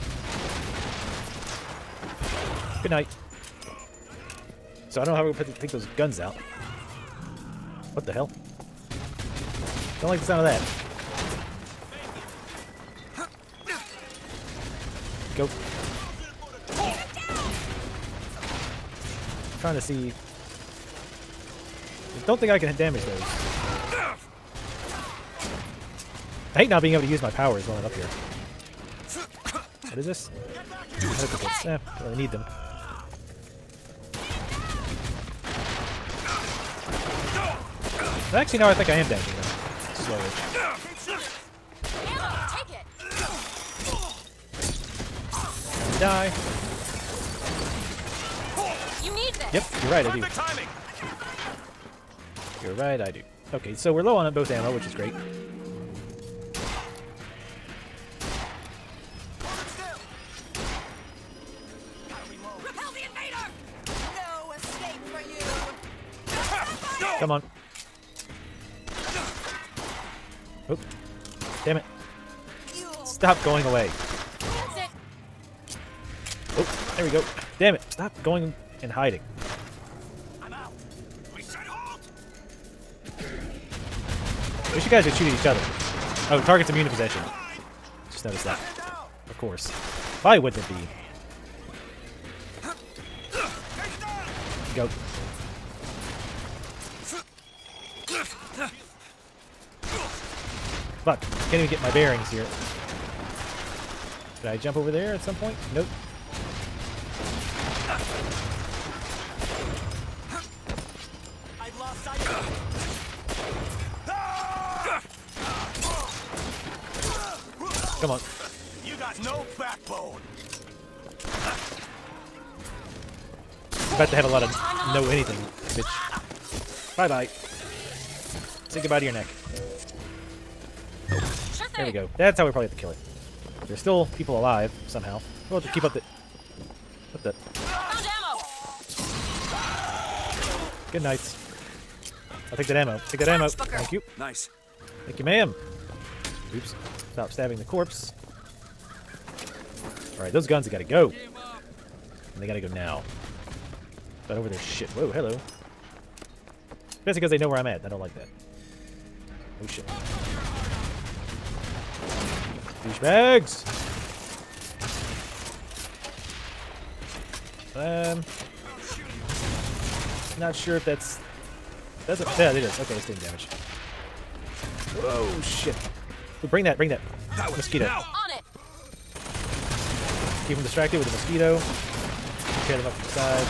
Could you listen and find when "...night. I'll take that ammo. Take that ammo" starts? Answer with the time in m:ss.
2:21.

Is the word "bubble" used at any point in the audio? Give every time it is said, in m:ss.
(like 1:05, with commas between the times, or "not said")
not said.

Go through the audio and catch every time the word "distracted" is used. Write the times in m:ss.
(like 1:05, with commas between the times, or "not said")
3:00.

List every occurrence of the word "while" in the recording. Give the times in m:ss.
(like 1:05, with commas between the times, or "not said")
0:27.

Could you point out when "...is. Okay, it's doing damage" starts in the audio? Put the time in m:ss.
2:52.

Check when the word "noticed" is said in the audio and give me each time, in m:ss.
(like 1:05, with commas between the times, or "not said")
1:28.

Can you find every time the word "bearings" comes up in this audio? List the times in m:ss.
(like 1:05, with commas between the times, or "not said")
1:41.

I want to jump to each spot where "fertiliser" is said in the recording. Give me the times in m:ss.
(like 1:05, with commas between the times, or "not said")
not said.